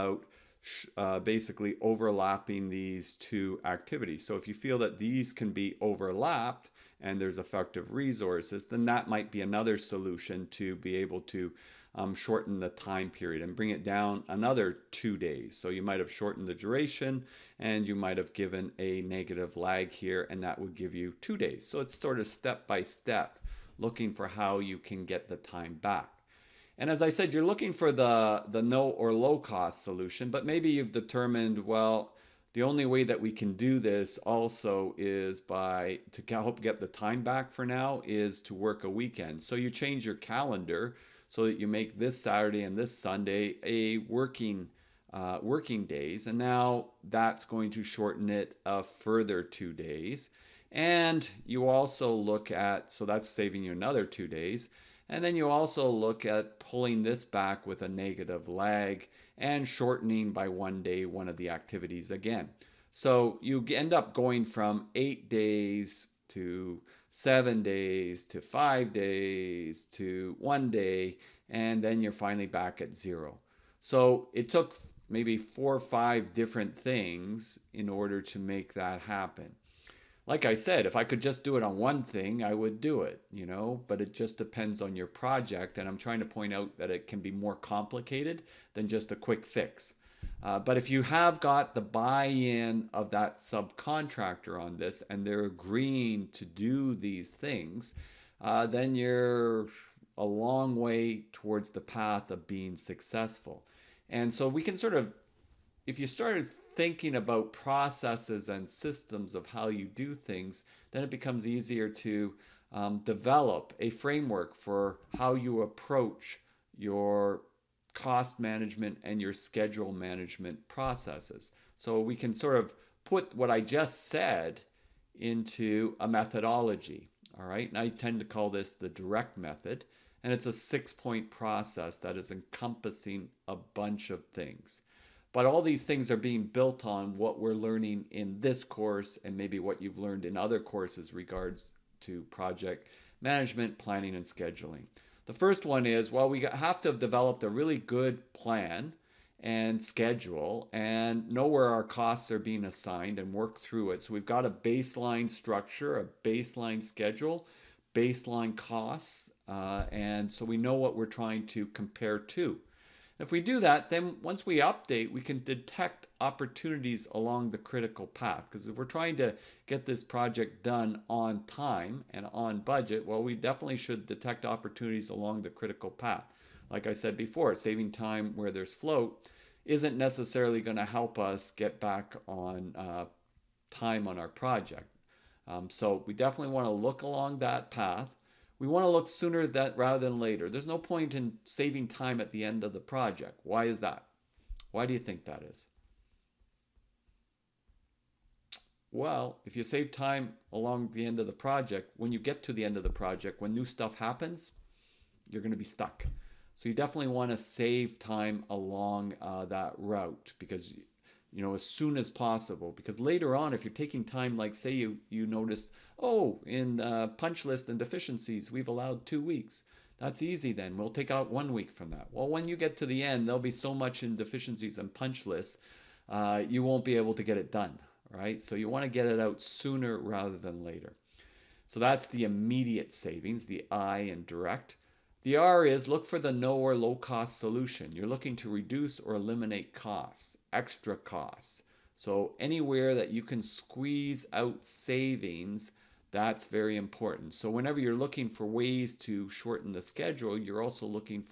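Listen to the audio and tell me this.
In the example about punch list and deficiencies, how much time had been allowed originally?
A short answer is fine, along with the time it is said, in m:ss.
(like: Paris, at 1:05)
2 weeks, at 3:39.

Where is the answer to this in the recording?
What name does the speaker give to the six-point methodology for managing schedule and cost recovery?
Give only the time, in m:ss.
2:08.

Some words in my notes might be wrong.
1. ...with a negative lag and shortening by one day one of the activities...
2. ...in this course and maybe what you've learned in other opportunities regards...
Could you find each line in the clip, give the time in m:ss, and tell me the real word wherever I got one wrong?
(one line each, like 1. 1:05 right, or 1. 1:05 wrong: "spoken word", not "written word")
1. 0:57 right
2. 2:18 wrong: "courses", not "opportunities".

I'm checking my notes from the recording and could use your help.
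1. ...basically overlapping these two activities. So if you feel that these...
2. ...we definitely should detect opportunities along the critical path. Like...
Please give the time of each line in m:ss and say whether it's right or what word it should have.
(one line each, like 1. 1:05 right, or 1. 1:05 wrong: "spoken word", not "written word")
1. 0:01 right
2. 2:53 right.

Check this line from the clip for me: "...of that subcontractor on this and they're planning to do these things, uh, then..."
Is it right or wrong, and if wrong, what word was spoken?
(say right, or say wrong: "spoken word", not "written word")
wrong: "agreeing", not "planning".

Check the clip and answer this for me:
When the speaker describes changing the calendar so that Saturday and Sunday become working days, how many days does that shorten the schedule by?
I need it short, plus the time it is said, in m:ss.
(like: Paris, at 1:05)
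2 days, at 0:48.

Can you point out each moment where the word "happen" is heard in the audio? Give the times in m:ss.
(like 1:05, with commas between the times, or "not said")
1:19, 3:23.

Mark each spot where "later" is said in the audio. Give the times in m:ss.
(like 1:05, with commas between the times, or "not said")
3:10, 3:32, 3:50.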